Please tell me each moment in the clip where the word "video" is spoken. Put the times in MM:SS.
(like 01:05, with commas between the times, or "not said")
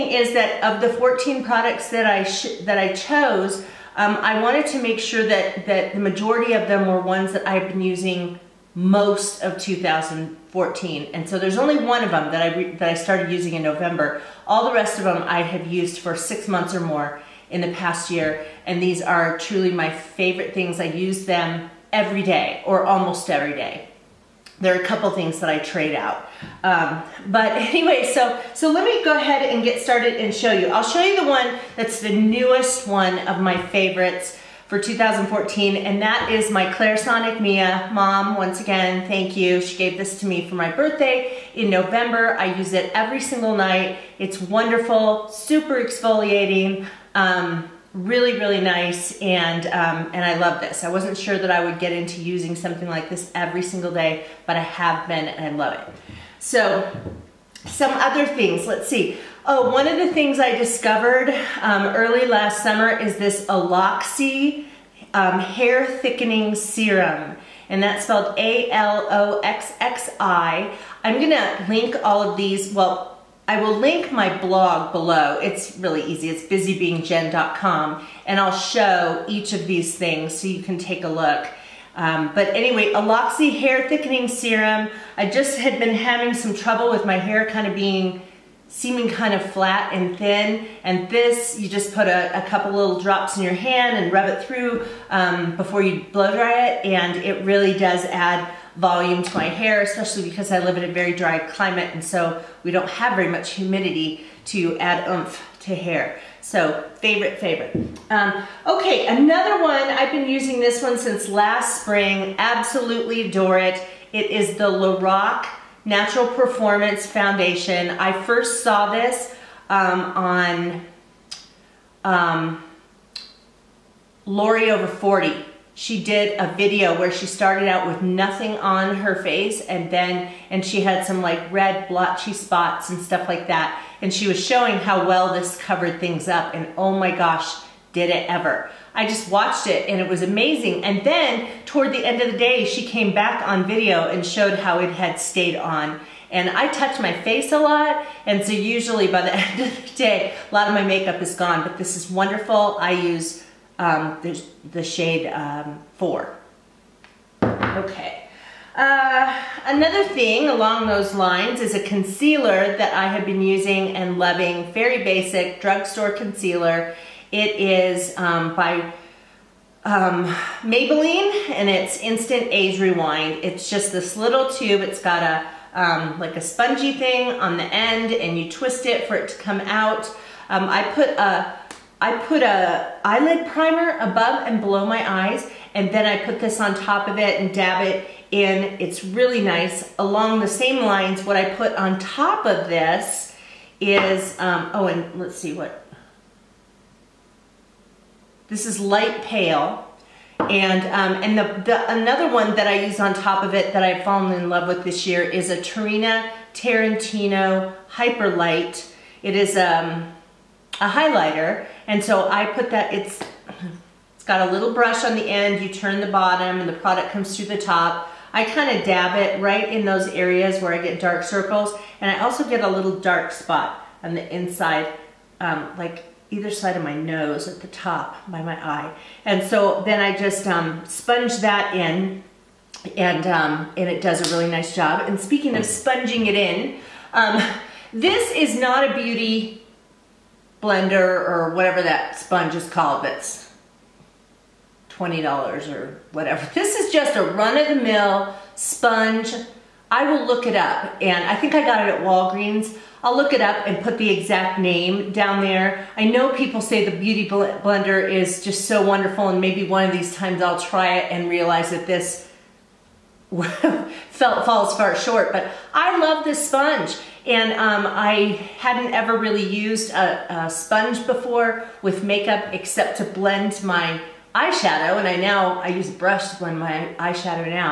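02:06, 02:23.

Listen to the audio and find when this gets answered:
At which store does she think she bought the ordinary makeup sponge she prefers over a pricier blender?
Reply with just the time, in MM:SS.
04:11.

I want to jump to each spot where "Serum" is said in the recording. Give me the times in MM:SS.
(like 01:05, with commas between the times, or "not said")
01:06, 01:24.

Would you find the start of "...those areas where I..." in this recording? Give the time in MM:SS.
03:39.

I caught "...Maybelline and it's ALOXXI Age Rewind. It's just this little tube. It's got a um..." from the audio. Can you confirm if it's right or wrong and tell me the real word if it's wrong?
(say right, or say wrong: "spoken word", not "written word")
wrong: "Instant", not "ALOXXI".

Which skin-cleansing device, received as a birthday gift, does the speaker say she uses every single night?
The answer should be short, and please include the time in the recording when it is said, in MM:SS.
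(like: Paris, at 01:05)
Clarisonic Mia, at 00:36.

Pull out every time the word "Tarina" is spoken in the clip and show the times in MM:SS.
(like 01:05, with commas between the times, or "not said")
03:25.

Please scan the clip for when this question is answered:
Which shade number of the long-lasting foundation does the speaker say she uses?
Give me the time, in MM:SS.
02:35.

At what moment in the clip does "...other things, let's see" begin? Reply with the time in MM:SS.
00:57.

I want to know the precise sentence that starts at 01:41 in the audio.
And so we don't have very much humidity to add oomph to hair.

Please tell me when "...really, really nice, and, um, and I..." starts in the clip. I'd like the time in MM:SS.
00:47.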